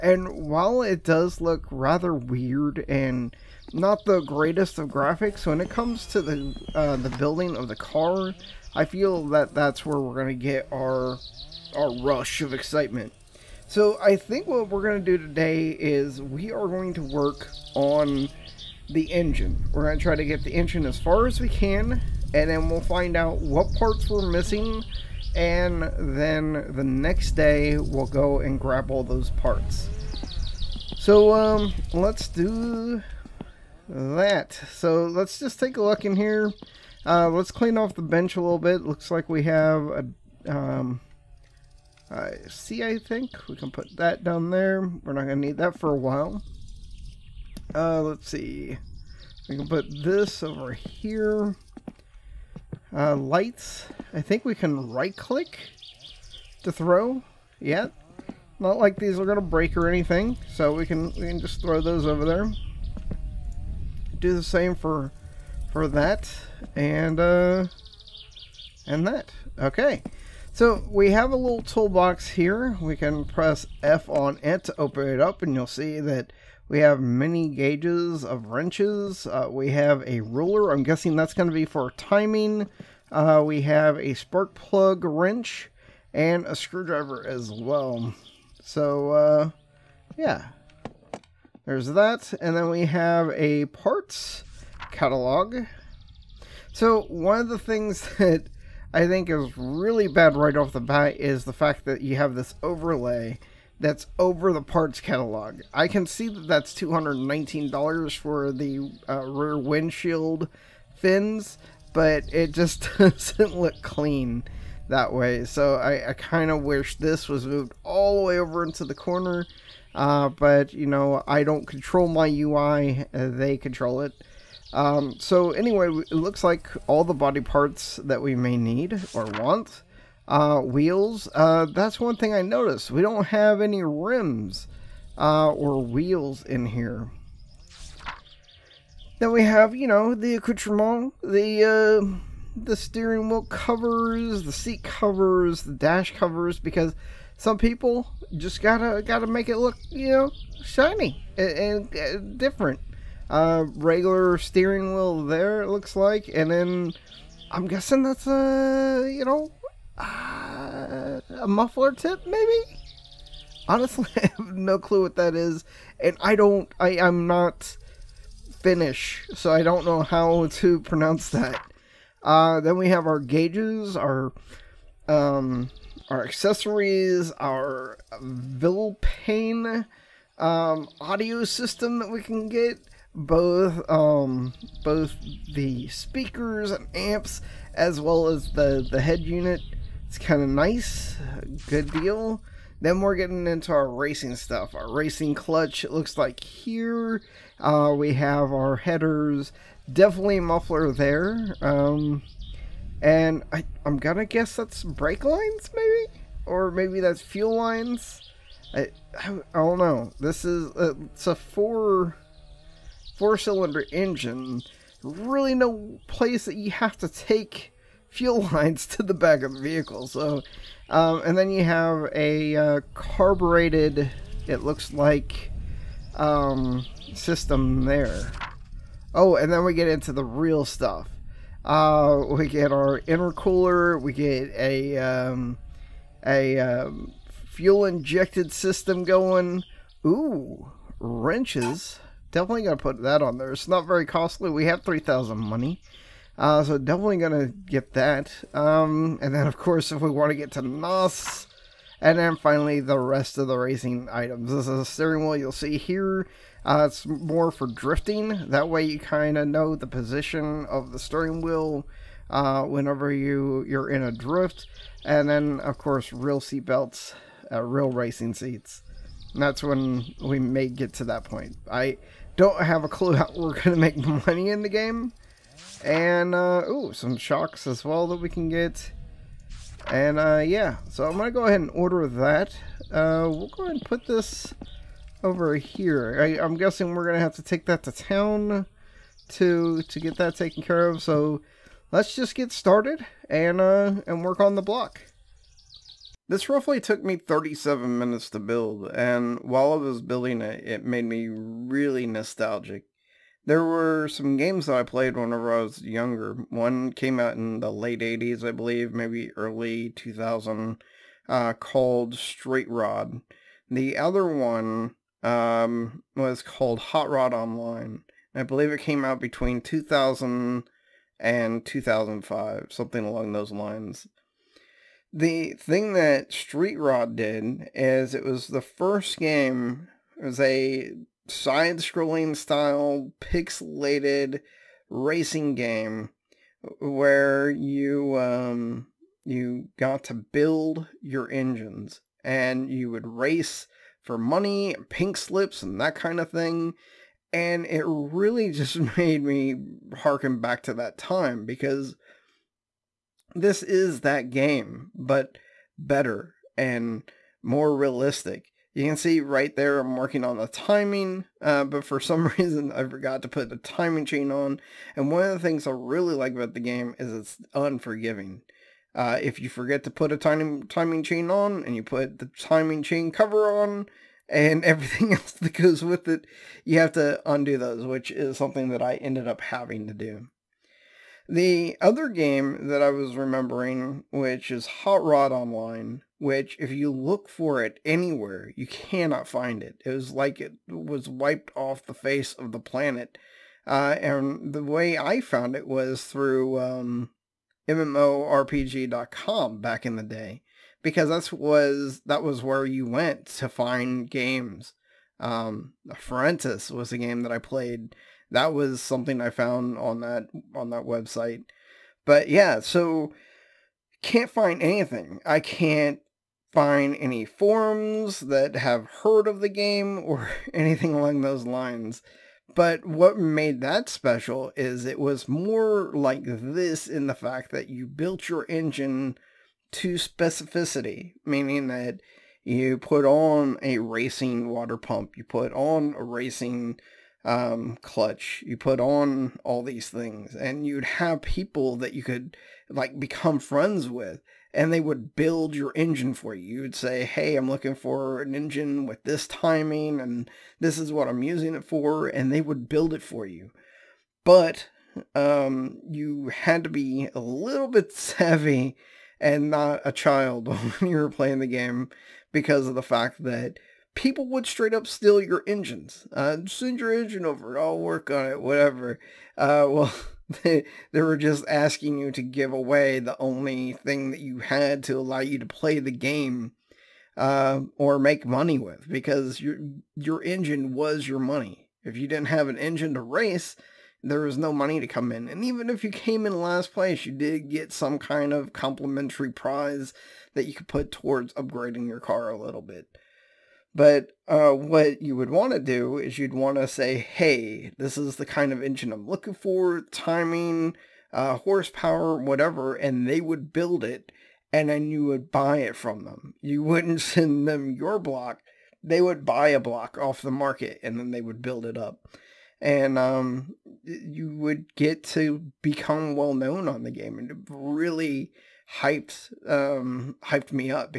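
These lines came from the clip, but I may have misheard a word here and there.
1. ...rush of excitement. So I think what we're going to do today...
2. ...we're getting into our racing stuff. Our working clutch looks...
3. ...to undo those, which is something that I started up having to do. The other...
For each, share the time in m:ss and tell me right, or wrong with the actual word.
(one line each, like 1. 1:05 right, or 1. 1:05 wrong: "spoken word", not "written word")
1. 0:12 right
2. 3:13 wrong: "racing", not "working"
3. 6:16 wrong: "ended", not "started".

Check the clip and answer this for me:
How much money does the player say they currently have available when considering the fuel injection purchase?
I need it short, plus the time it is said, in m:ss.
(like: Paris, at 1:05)
3,000, at 4:04.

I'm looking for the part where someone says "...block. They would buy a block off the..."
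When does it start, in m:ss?
8:27.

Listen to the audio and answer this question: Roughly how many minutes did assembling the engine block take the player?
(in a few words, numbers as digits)
37.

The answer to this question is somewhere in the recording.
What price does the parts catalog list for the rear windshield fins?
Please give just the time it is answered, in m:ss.
1:46.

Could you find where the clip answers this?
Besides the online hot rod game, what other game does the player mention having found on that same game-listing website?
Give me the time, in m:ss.
6:45.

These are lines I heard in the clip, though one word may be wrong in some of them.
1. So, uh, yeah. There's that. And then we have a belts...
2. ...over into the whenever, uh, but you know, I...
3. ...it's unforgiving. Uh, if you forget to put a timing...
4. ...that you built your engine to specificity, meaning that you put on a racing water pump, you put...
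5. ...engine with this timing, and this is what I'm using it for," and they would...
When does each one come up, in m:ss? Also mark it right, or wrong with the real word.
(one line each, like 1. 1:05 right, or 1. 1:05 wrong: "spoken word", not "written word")
1. 1:28 wrong: "parts", not "belts"
2. 1:58 wrong: "corner", not "whenever"
3. 6:07 right
4. 7:07 right
5. 7:28 right.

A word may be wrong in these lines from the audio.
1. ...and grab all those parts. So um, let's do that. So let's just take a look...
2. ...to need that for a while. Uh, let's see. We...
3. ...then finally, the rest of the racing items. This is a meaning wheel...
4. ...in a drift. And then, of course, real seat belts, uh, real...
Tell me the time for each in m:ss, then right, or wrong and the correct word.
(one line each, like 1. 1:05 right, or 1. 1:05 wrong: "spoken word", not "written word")
1. 0:28 right
2. 0:45 right
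3. 4:12 wrong: "steering", not "meaning"
4. 4:23 right.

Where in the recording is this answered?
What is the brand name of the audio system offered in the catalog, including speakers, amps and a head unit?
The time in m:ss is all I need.
2:58.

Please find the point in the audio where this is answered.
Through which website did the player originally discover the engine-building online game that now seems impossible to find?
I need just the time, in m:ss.
6:37.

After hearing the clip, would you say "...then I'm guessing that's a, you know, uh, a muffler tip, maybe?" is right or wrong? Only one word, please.
right.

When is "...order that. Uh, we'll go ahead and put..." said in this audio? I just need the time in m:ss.
4:41.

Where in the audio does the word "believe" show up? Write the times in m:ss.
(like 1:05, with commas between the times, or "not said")
5:08, 5:18.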